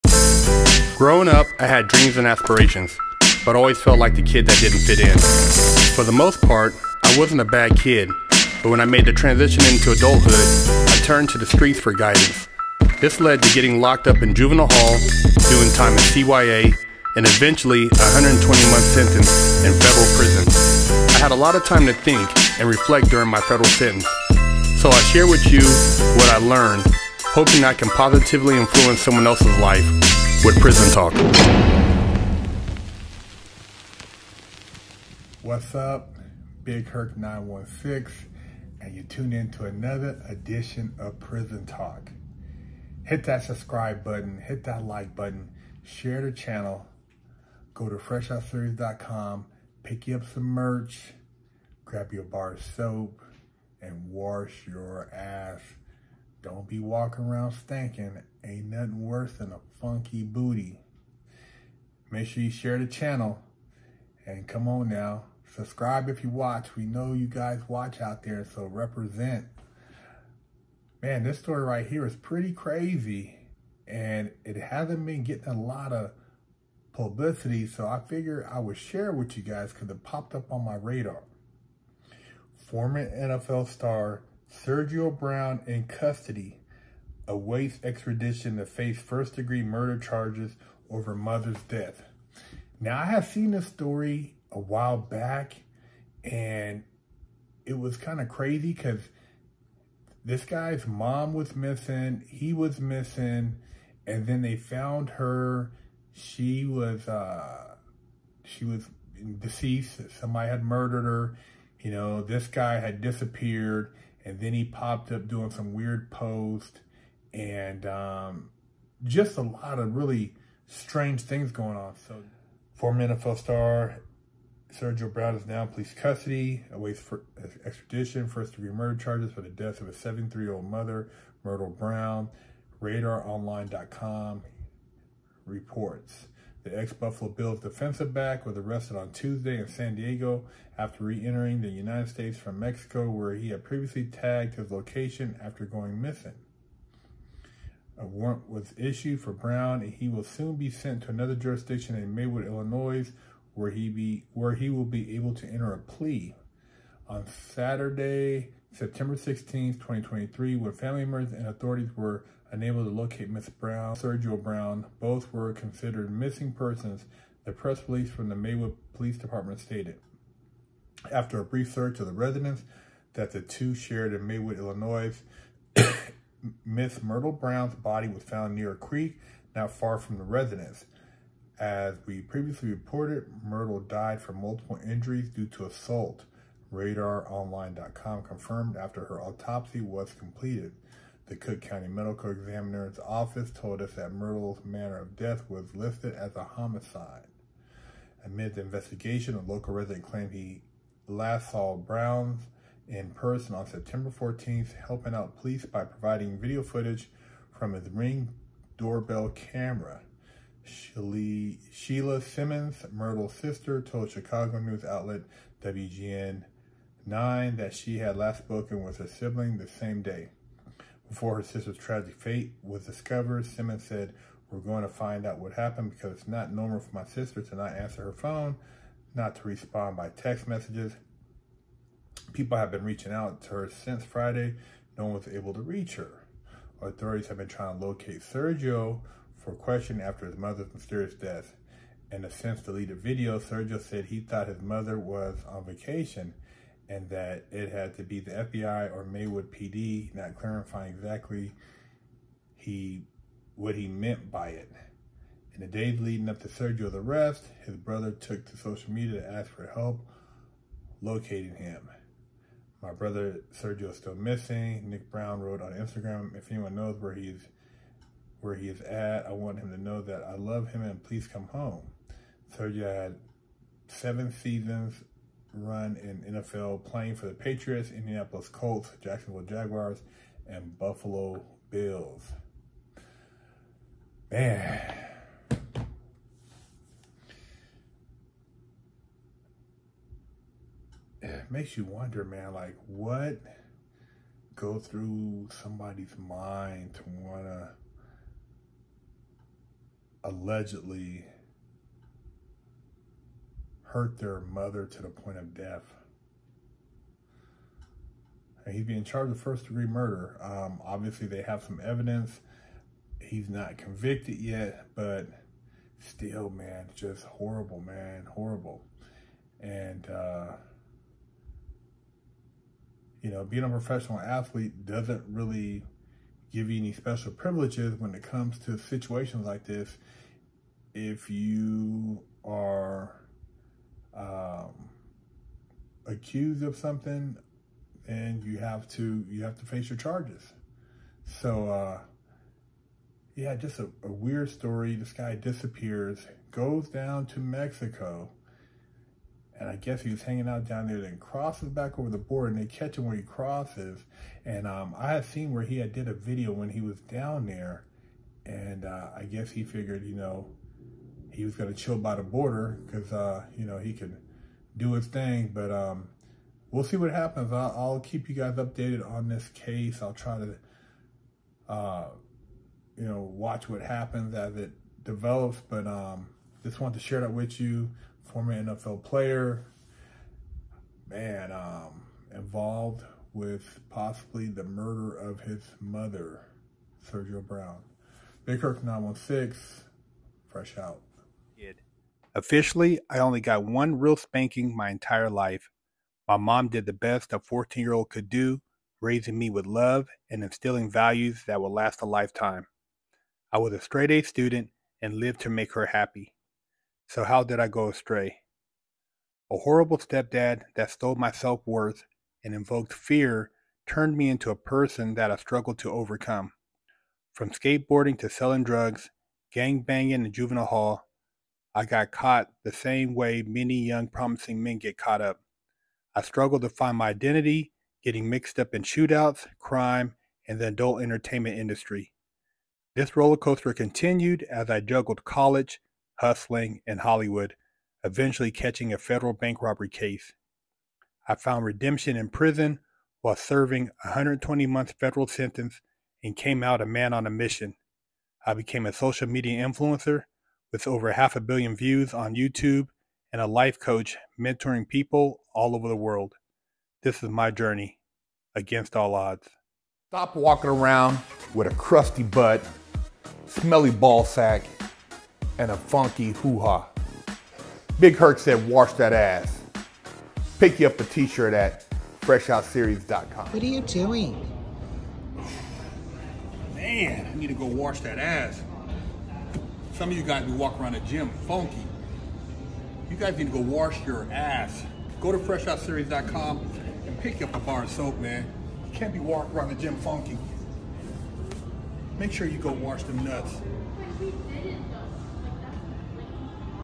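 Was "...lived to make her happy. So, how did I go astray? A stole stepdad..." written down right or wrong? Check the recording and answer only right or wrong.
wrong.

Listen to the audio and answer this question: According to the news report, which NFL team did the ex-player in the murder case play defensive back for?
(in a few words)
Buffalo Bills.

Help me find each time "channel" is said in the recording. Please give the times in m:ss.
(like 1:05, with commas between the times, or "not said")
0:46, 1:02.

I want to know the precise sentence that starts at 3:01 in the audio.
As we previously reported, Myrtle died from multiple injuries due to assault.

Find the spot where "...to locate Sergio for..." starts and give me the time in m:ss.
3:57.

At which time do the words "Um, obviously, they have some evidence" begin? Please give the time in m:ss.
5:10.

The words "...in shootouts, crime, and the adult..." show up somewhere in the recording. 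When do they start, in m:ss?
7:08.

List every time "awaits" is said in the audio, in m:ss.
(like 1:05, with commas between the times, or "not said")
1:27, 2:06.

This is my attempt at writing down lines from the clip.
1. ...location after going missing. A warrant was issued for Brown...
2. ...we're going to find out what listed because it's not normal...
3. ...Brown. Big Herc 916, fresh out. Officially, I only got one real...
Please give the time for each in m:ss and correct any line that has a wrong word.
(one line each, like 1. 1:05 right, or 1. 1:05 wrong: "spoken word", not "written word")
1. 2:24 right
2. 3:44 wrong: "happened", not "listed"
3. 6:27 right.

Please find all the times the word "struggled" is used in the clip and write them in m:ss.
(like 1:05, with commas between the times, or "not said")
6:55, 7:06.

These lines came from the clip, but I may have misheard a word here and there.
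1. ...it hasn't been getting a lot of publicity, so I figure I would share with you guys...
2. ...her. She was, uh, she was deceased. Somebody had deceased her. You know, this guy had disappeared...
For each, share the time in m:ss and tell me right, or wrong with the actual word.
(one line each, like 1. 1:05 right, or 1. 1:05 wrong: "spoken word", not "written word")
1. 1:14 right
2. 1:45 wrong: "murdered", not "deceased".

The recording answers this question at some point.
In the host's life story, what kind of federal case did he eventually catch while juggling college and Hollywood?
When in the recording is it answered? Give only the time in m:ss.
7:19.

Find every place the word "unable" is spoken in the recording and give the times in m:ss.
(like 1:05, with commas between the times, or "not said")
2:42.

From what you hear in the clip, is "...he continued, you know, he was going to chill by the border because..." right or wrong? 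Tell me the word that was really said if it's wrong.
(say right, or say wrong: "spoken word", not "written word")
wrong: "figured", not "continued".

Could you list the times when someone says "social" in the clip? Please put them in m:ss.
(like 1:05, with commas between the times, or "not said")
4:18, 7:28.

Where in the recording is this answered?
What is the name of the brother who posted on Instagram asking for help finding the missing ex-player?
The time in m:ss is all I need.
4:24.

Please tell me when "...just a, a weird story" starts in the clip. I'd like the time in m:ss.
5:43.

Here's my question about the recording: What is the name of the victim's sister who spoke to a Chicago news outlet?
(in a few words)
Sheila Simmons.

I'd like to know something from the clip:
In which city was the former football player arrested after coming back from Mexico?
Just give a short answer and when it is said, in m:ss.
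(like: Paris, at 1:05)
San Diego, at 2:19.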